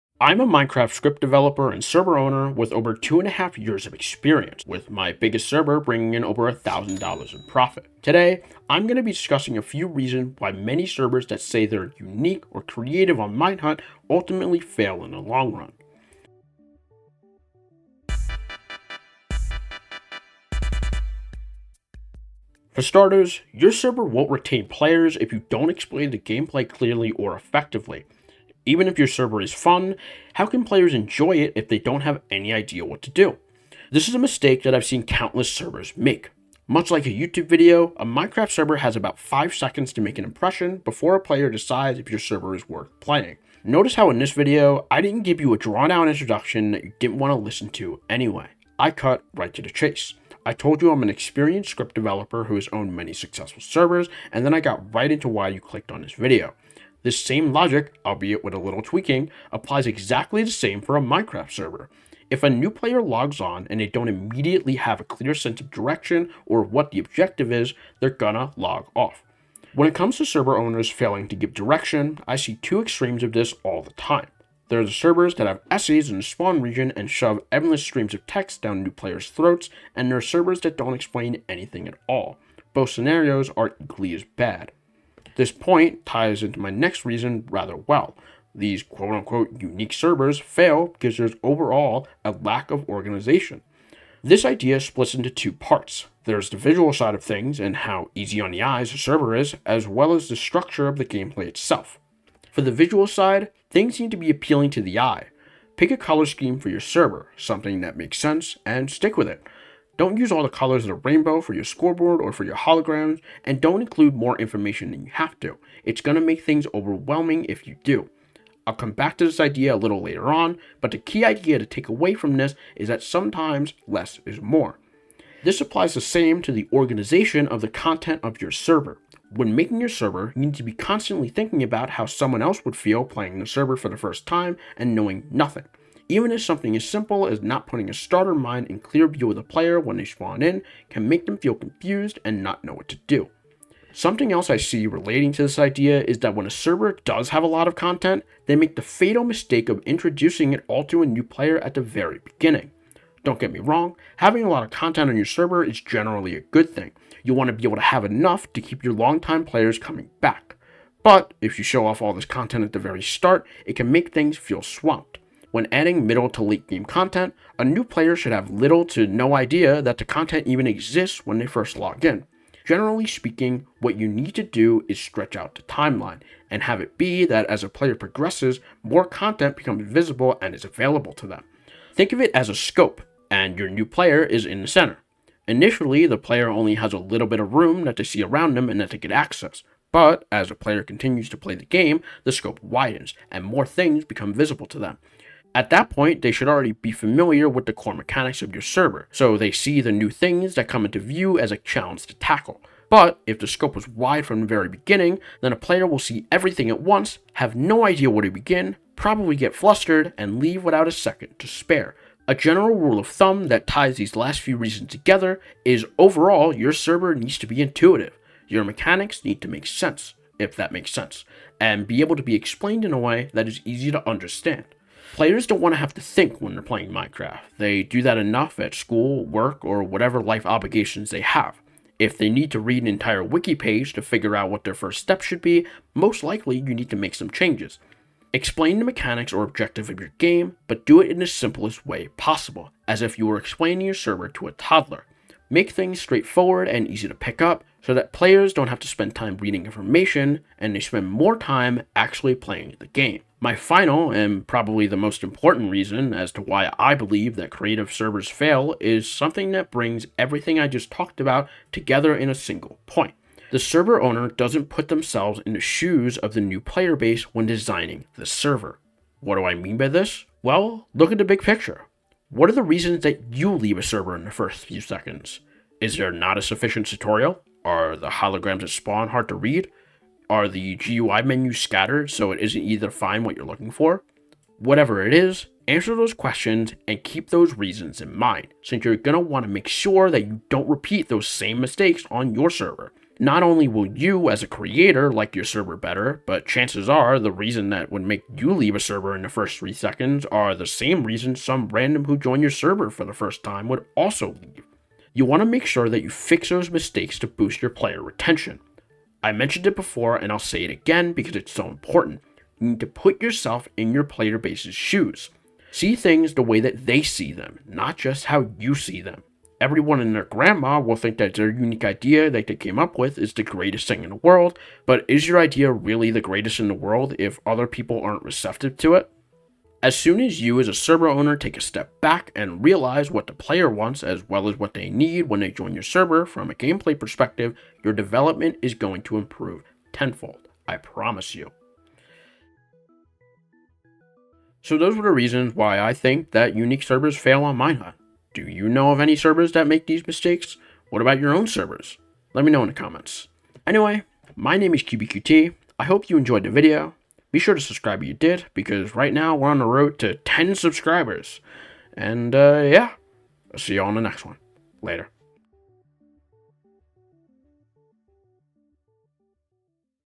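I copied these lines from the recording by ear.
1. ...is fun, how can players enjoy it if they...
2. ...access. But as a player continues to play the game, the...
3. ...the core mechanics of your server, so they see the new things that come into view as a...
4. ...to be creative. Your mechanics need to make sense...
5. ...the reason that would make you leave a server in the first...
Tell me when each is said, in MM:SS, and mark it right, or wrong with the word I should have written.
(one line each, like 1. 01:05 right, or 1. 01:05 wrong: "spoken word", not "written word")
1. 00:29 right
2. 03:09 right
3. 03:17 right
4. 03:37 wrong: "intuitive", not "creative"
5. 04:57 right.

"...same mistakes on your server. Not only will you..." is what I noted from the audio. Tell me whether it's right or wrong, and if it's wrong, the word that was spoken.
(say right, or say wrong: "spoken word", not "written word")
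right.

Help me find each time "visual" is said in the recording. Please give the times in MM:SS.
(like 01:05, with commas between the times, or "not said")
01:36, 01:42.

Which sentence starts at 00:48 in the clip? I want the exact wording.
I cut right to the chase.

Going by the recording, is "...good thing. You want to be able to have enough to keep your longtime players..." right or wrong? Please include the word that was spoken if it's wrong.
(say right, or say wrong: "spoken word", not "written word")
right.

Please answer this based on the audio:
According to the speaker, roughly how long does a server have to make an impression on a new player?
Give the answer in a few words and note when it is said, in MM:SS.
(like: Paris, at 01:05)
5 seconds, at 00:39.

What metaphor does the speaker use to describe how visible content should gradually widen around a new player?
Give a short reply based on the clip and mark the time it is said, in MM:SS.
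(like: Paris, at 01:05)
a scope, at 03:02.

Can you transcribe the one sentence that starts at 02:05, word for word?
This applies the same to the organization of the content of your server.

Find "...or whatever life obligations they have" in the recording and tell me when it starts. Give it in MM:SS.
03:49.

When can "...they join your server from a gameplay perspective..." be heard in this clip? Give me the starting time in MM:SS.
05:35.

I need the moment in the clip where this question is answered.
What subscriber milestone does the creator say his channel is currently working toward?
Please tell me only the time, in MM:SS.
06:00.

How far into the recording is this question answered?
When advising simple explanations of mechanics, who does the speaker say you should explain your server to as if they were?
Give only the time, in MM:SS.
04:04.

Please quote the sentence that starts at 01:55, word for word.
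It's going to make things overwhelming if you do.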